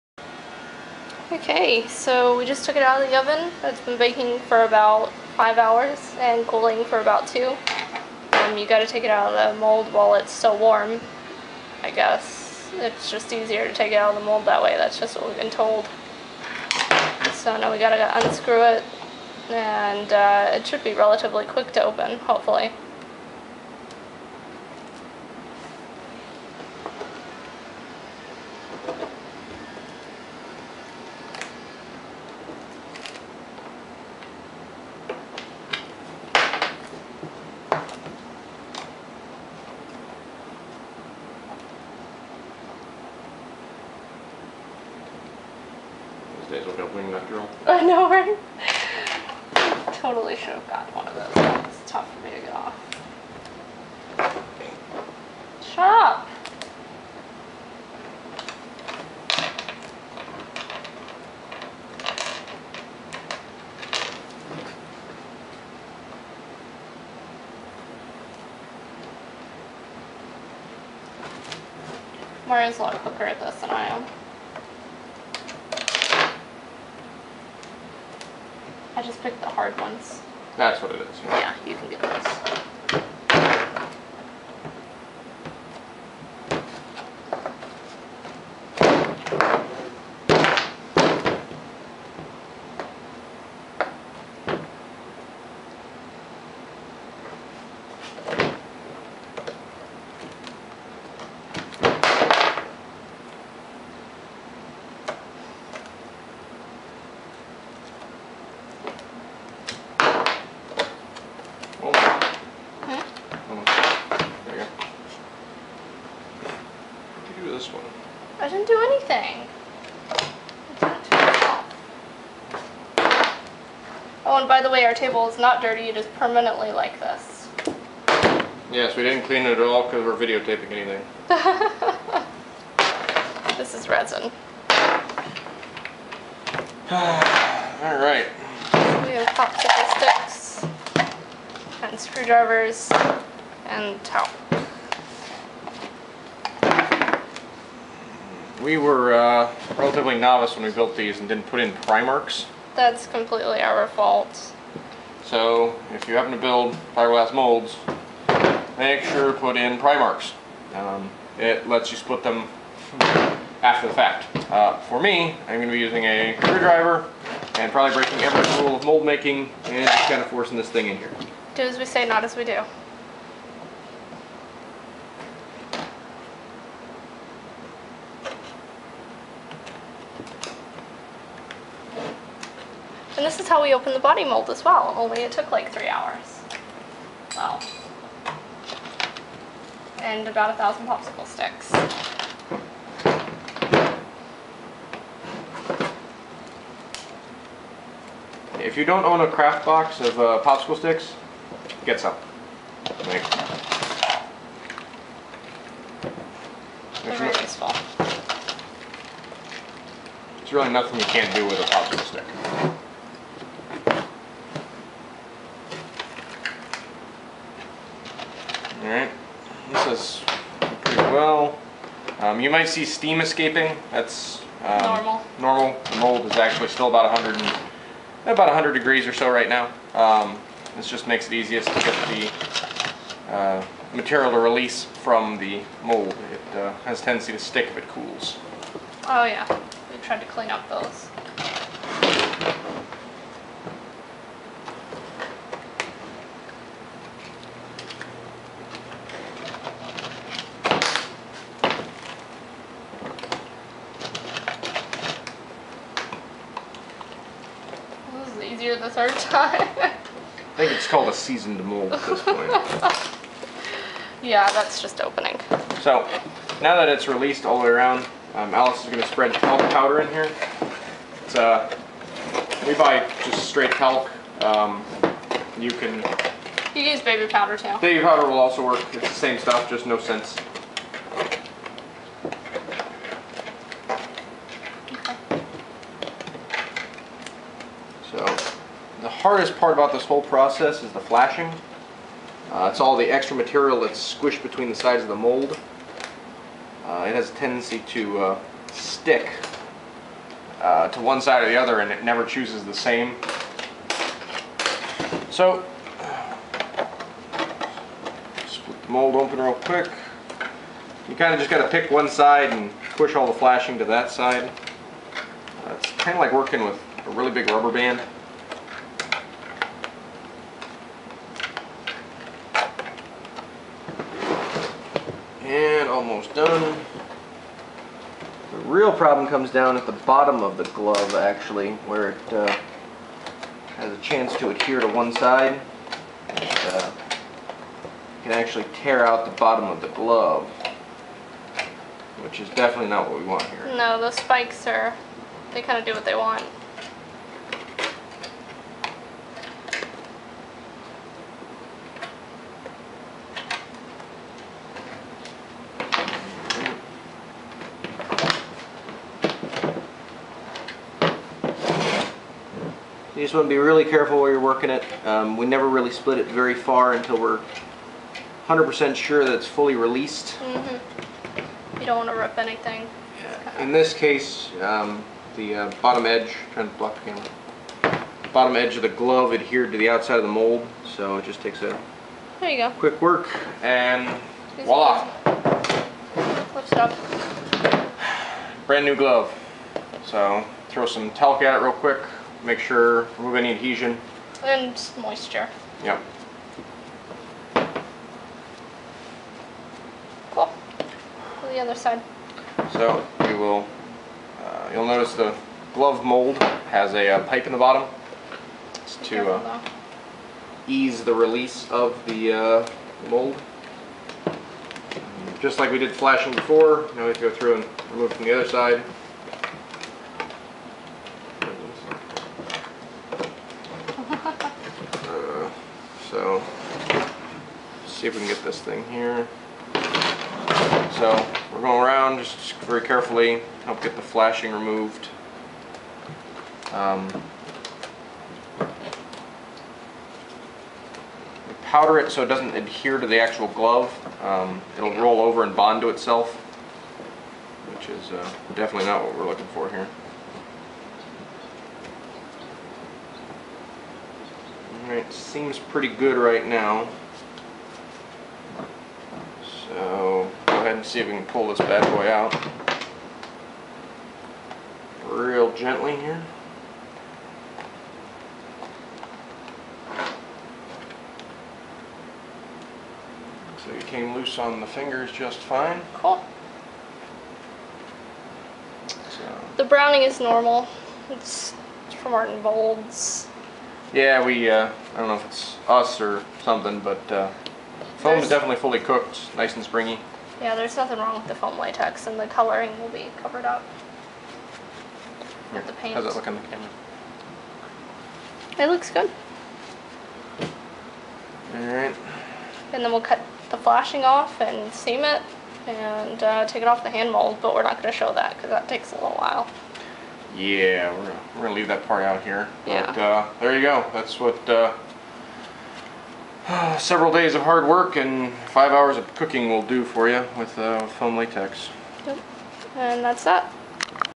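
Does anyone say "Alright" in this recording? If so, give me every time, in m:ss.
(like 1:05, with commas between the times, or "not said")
3:38, 7:34.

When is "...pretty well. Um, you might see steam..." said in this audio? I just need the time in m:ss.
3:40.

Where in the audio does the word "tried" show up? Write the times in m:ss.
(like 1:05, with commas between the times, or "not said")
4:00.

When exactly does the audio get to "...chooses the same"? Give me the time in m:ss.
5:02.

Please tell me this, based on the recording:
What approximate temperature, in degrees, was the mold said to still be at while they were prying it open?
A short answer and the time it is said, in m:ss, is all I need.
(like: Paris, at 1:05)
100 degrees, at 3:48.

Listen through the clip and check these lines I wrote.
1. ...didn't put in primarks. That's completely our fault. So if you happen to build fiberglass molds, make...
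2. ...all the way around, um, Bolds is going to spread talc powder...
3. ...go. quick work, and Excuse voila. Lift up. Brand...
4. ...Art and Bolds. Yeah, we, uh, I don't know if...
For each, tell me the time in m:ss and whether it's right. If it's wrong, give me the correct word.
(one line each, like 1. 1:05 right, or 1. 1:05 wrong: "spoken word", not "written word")
1. 2:31 right
2. 4:27 wrong: "Alice", not "Bolds"
3. 6:22 right
4. 8:02 right.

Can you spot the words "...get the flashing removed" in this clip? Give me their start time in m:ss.
7:13.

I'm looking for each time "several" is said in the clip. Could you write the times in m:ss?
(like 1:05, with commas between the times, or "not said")
8:36.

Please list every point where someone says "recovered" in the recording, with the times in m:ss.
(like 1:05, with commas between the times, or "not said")
not said.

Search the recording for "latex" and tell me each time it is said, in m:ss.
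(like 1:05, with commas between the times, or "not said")
8:11, 8:41.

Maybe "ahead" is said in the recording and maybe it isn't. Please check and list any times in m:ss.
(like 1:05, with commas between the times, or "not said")
7:40.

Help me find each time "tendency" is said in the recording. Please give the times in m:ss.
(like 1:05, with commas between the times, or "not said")
3:56, 4:57.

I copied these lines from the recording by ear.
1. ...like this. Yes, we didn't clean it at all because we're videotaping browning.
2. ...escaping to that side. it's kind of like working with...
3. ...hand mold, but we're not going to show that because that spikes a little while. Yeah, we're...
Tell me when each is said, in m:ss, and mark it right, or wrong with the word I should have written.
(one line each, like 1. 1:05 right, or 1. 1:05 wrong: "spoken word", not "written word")
1. 2:06 wrong: "anything", not "browning"
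2. 5:13 wrong: "flashing", not "escaping"
3. 8:26 wrong: "takes", not "spikes".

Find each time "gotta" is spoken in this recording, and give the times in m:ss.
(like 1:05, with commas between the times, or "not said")
0:08, 0:17.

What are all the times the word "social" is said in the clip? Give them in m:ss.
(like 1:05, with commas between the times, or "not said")
not said.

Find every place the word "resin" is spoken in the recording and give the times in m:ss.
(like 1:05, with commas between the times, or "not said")
2:13.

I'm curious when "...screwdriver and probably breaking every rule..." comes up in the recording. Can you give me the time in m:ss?
2:46.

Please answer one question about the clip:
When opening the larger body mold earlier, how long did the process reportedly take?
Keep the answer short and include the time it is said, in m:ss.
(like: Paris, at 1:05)
3 hours, at 3:05.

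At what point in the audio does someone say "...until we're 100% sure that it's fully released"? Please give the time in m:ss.
6:06.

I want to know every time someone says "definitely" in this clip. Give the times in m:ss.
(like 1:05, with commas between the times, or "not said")
5:42, 7:28, 8:08.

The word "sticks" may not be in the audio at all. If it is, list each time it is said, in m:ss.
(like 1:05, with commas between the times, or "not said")
2:20, 3:11, 3:20, 3:32, 3:57, 4:58.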